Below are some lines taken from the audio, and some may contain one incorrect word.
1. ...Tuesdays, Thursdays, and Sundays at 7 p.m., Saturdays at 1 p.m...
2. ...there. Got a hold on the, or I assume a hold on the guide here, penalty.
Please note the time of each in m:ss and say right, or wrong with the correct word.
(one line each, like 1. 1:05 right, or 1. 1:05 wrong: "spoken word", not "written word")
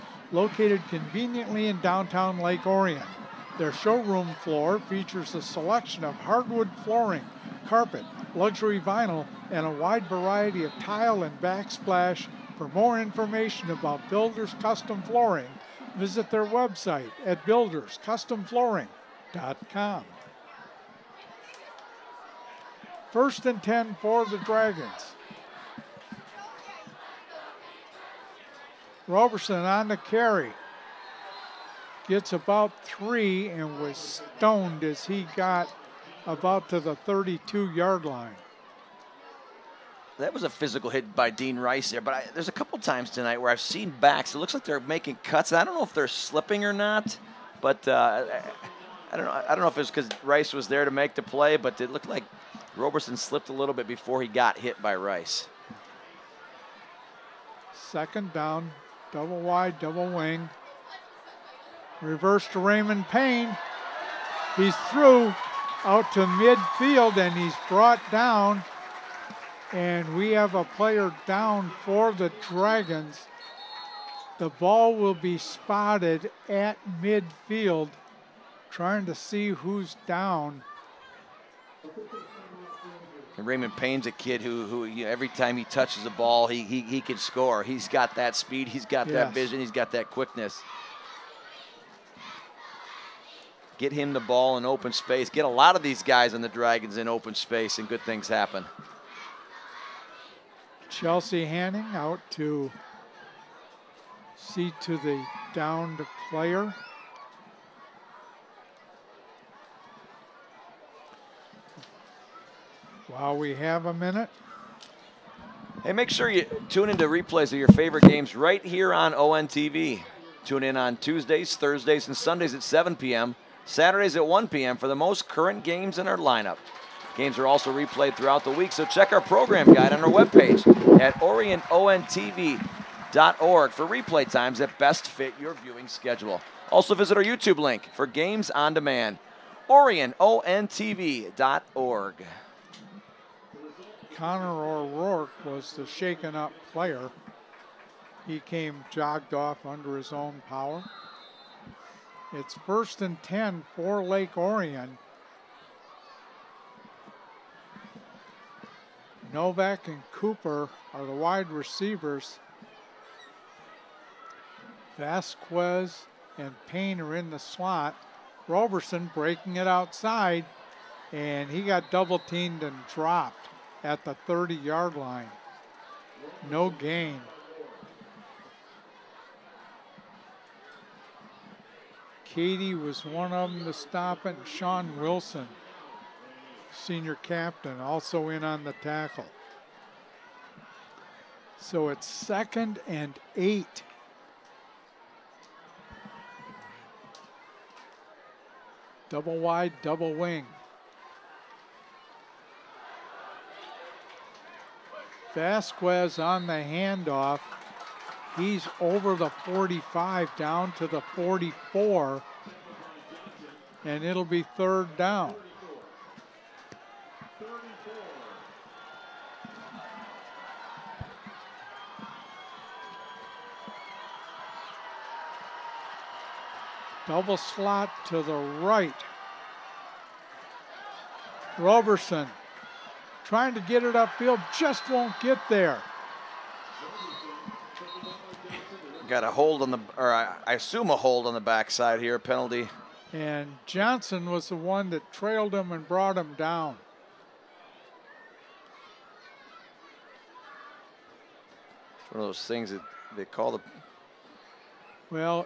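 1. 2:00 right
2. 3:55 wrong: "backside", not "guide".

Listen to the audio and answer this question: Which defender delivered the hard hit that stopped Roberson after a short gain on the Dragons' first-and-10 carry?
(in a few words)
Dean Rice.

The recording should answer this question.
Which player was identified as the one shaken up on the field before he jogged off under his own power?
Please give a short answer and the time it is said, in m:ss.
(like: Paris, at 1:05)
Connor O'Rourke, at 2:24.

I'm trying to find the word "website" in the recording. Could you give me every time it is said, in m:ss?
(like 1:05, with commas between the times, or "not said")
0:16.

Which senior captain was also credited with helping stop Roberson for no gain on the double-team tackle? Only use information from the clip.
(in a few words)
Sean Wilson.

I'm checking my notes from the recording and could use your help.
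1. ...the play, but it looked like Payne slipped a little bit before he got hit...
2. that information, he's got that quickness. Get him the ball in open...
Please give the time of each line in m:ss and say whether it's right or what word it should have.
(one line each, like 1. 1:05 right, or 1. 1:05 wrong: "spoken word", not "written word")
1. 0:51 wrong: "Roberson", not "Payne"
2. 1:29 wrong: "vision", not "information".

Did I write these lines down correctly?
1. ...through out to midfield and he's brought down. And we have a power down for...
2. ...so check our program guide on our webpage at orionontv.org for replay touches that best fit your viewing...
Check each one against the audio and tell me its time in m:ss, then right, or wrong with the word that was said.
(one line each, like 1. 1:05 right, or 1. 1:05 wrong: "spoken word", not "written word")
1. 1:04 wrong: "player", not "power"
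2. 2:08 wrong: "times", not "touches".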